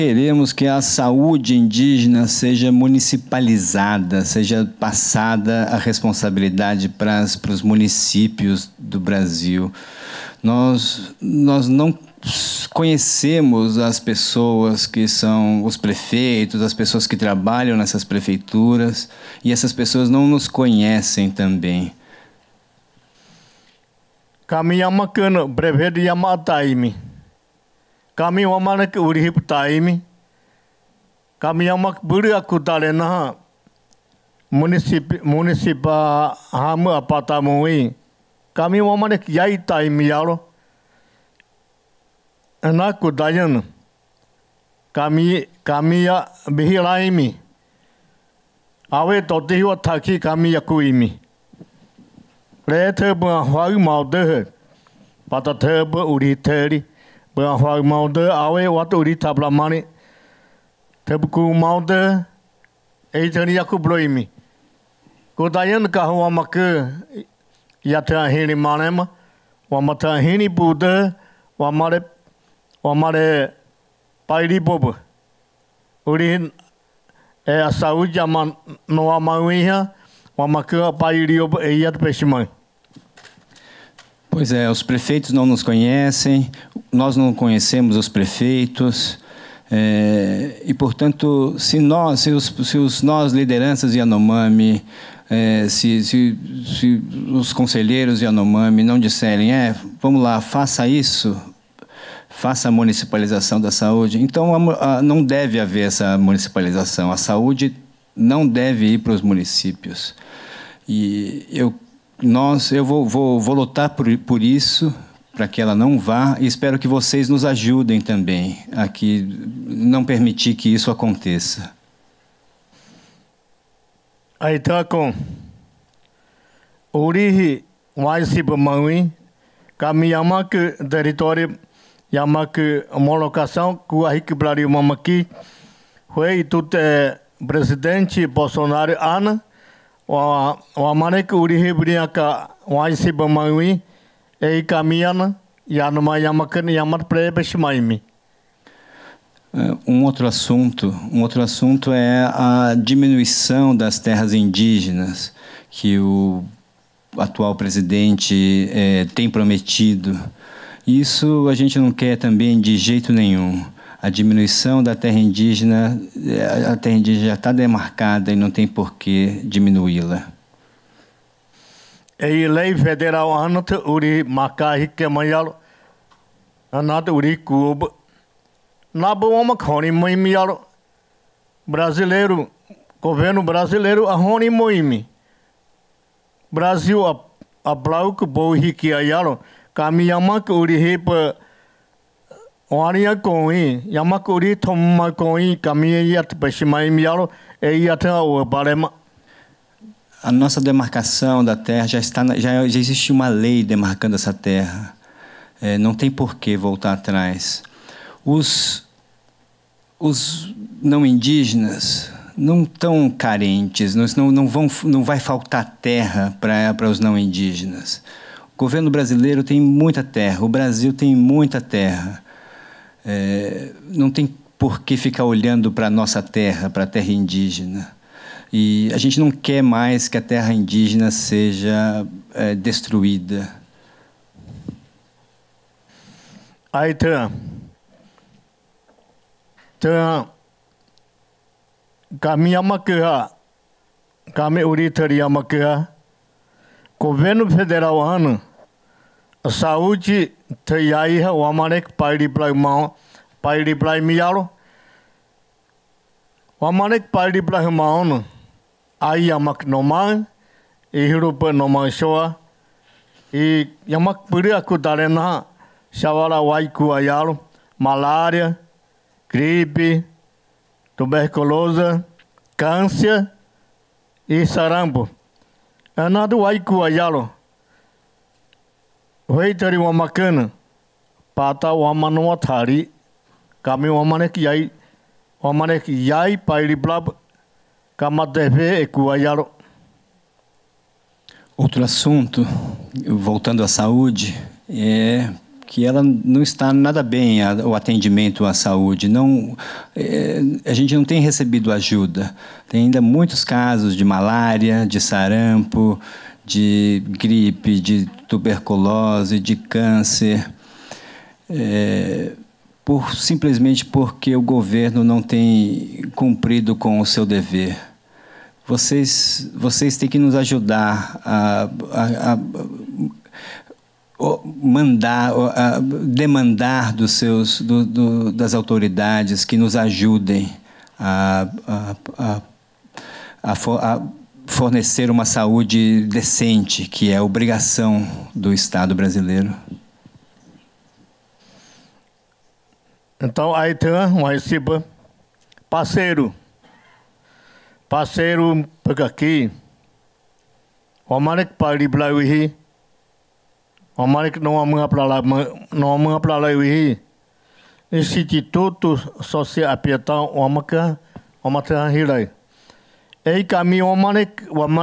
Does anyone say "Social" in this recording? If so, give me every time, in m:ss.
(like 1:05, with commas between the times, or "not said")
5:59.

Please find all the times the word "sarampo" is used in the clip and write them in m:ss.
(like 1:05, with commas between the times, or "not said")
4:34, 5:04.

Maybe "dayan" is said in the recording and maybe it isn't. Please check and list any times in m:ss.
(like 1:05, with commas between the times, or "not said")
0:43, 1:05.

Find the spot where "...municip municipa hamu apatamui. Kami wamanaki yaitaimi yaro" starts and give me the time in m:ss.
0:34.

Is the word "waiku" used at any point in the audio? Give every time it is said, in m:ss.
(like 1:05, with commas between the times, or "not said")
4:26, 4:36.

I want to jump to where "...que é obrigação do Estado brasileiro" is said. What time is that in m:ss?
5:36.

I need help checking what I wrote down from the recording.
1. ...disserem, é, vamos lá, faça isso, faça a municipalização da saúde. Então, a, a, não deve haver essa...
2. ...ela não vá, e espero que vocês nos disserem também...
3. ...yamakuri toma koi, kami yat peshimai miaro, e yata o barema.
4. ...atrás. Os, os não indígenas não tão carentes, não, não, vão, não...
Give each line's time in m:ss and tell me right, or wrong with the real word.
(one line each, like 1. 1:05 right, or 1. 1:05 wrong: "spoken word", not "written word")
1. 1:38 right
2. 1:55 wrong: "ajudem", not "disserem"
3. 3:13 right
4. 3:26 right.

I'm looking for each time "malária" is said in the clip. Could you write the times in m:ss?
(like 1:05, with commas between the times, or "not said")
4:27, 5:04.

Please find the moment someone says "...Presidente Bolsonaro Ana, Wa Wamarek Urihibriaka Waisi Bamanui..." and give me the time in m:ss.
2:17.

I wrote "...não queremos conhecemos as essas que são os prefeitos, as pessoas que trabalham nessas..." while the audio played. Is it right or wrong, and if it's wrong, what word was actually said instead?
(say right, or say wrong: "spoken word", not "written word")
wrong: "pessoas", not "essas".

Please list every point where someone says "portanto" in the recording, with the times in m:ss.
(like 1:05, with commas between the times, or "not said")
1:30.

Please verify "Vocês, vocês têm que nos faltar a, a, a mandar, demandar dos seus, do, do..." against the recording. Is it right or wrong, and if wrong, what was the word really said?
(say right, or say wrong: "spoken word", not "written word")
wrong: "ajudar", not "faltar".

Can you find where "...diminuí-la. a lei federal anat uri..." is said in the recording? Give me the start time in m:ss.
2:49.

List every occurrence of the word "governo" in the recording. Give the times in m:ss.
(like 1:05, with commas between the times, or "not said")
3:02, 3:38, 4:06, 5:14.